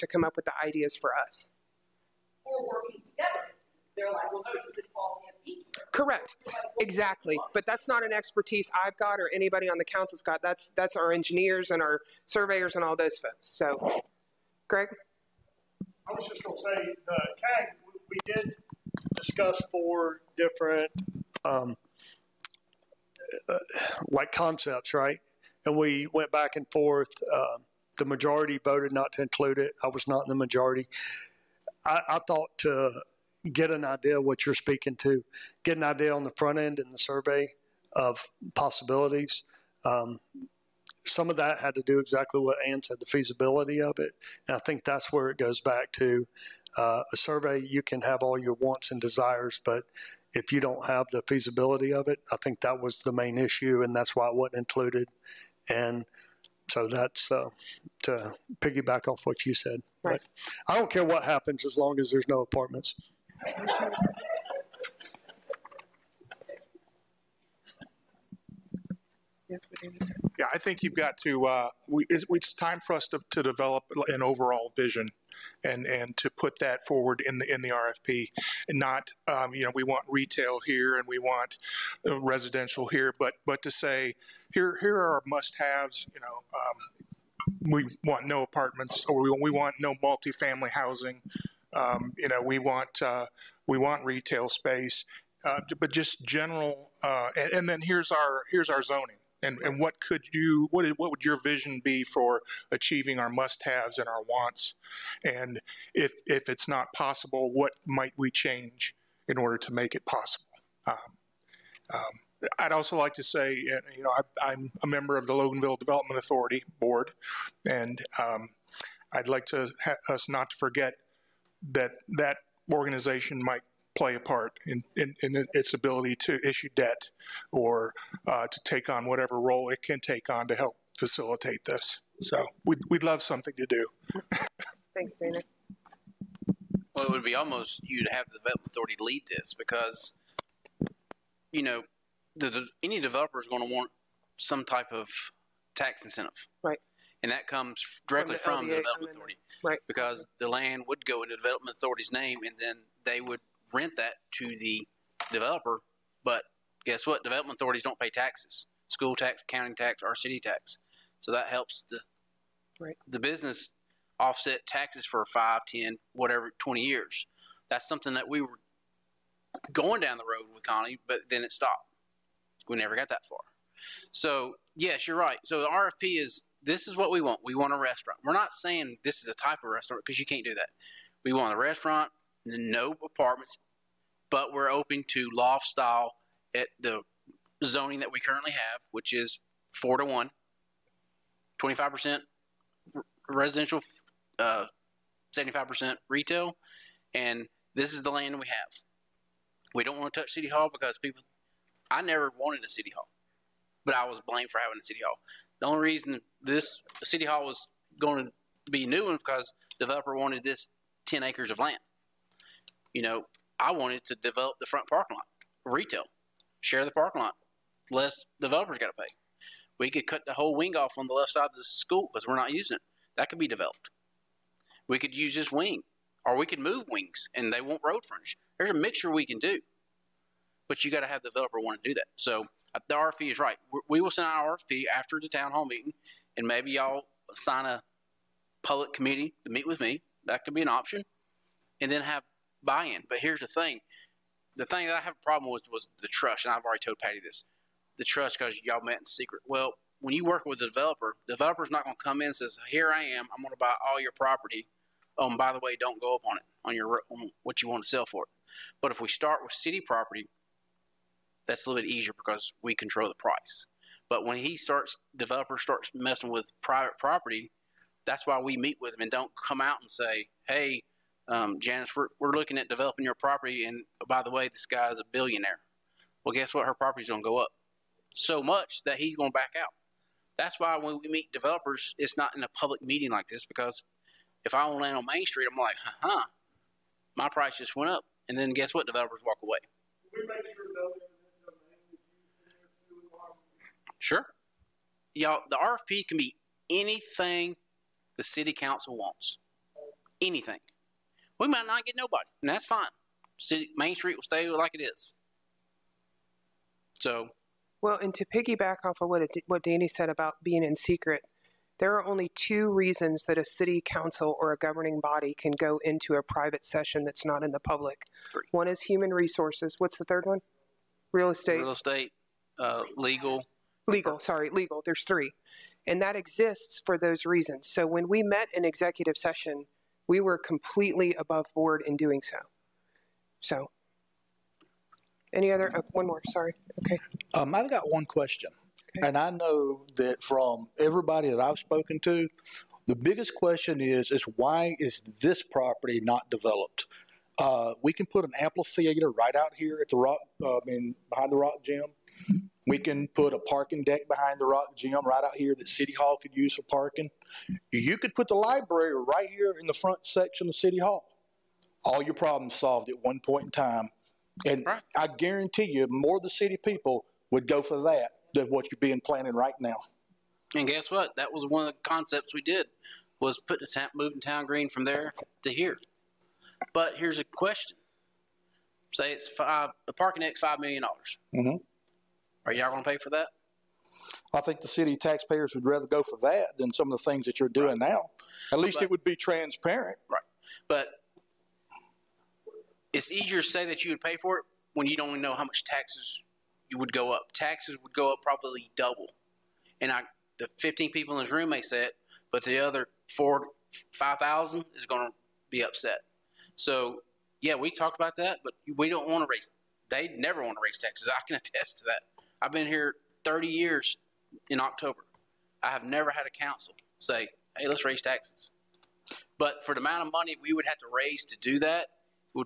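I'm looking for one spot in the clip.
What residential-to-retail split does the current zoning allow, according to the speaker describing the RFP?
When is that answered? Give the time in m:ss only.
3:11.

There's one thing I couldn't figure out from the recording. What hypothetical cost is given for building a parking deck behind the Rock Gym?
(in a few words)
5 million dollars.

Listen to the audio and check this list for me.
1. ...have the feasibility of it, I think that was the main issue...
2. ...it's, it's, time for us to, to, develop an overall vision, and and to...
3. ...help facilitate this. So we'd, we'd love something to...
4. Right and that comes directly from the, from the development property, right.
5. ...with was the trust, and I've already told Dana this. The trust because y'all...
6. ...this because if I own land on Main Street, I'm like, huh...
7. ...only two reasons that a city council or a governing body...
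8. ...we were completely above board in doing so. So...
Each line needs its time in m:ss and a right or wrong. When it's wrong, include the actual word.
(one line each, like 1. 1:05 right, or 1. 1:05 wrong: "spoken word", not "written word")
1. 0:50 right
2. 1:12 right
3. 2:10 right
4. 2:26 wrong: "authority", not "property"
5. 4:05 wrong: "Patty", not "Dana"
6. 4:43 right
7. 5:12 right
8. 5:30 right.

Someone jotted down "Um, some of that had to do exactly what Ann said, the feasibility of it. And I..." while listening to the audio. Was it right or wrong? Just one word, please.
right.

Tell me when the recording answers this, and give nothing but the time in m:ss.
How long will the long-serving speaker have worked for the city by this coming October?
6:53.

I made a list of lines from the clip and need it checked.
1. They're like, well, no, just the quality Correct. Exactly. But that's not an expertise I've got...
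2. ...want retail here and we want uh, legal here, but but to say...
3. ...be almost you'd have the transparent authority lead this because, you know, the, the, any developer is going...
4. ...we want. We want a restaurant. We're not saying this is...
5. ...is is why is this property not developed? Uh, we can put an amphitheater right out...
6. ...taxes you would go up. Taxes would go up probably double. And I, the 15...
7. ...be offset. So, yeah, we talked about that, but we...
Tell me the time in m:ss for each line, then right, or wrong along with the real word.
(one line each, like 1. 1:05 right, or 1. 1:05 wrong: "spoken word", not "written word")
1. 0:03 right
2. 1:19 wrong: "residential", not "legal"
3. 2:17 wrong: "development", not "transparent"
4. 2:57 right
5. 5:43 right
6. 6:35 right
7. 6:45 wrong: "upset", not "offset".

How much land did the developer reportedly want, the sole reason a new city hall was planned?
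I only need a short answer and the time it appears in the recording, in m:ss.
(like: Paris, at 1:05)
10 acres, at 3:31.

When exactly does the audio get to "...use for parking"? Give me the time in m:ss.
5:56.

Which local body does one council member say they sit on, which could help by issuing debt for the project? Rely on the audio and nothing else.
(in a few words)
Loganville Development Authority Board.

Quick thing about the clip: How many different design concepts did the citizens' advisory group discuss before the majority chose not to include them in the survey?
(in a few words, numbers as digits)
4.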